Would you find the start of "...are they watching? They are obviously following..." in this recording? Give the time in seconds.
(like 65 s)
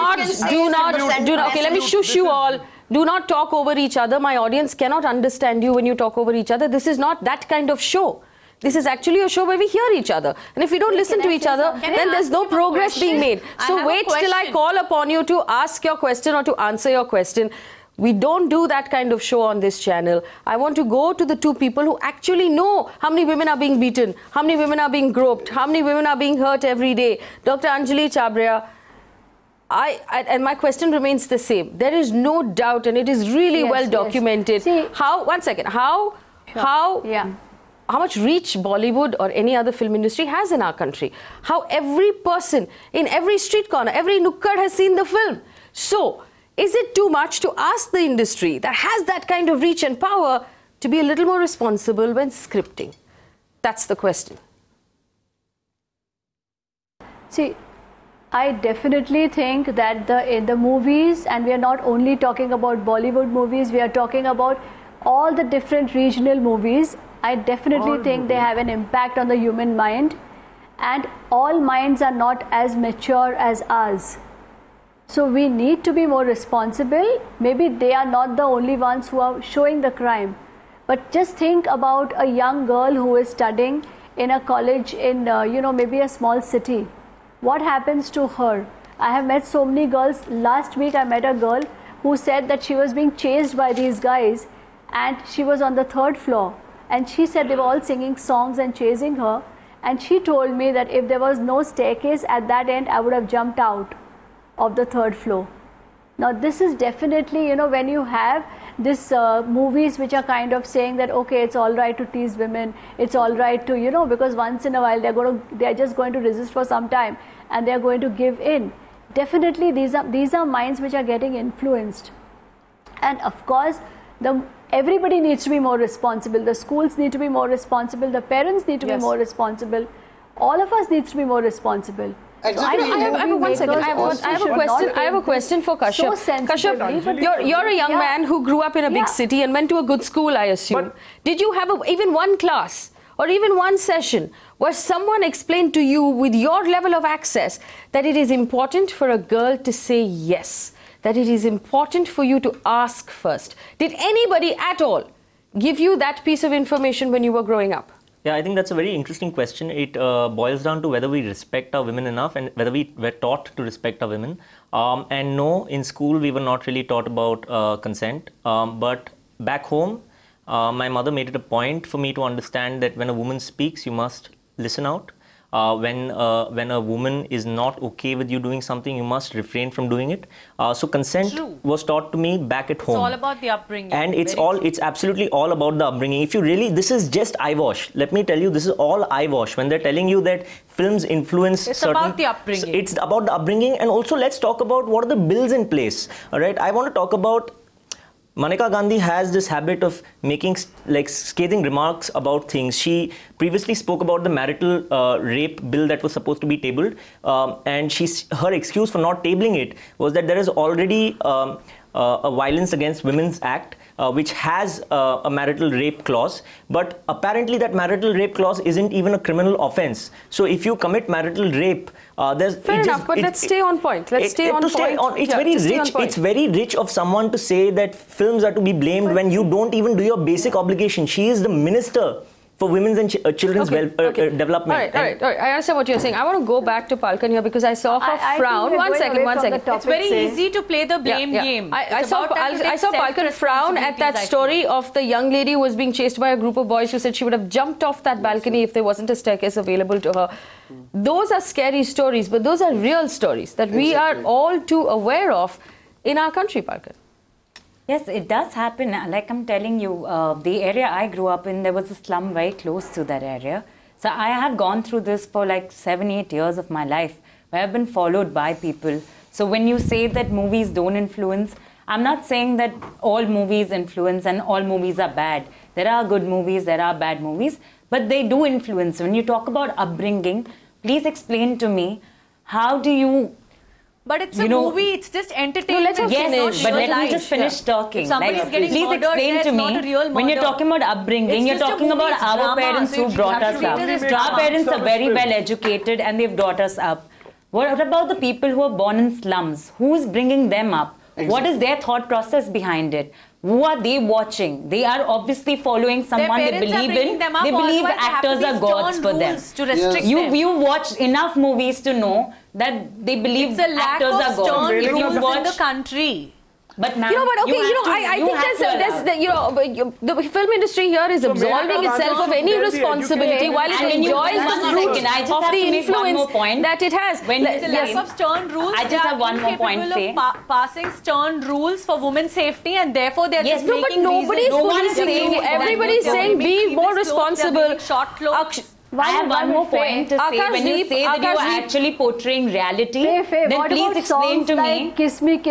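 303 s.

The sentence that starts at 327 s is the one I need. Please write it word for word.
When there's a lack of stern rules, I just have one more point.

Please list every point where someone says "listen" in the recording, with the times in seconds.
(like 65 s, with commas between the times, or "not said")
10 s, 174 s.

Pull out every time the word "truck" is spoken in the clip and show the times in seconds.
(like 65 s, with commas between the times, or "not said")
not said.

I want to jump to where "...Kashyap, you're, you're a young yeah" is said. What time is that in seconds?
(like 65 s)
136 s.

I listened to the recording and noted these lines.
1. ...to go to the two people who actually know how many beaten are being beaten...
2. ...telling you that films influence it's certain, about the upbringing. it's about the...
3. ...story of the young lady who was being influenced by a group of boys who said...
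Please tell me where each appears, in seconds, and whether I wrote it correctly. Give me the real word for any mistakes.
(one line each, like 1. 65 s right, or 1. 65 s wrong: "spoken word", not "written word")
1. 20 s wrong: "women", not "beaten"
2. 189 s right
3. 244 s wrong: "chased", not "influenced".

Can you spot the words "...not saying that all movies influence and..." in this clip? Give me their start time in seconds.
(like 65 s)
272 s.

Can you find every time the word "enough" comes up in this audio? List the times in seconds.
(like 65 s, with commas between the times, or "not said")
162 s, 222 s, 311 s.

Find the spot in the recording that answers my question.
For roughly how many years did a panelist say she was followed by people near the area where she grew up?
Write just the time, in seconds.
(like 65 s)
265 s.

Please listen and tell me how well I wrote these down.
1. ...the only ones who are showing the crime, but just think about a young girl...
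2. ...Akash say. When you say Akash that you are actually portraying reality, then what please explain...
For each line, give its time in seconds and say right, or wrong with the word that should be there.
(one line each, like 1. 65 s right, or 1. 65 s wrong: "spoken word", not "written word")
1. 78 s right
2. 340 s right.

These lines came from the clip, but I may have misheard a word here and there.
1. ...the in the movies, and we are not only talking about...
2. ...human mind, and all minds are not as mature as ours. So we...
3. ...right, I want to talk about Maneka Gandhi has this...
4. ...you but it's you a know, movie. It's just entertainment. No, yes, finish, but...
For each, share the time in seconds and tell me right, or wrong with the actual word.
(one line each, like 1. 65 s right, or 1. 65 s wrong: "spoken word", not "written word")
1. 60 s right
2. 69 s right
3. 196 s right
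4. 282 s right.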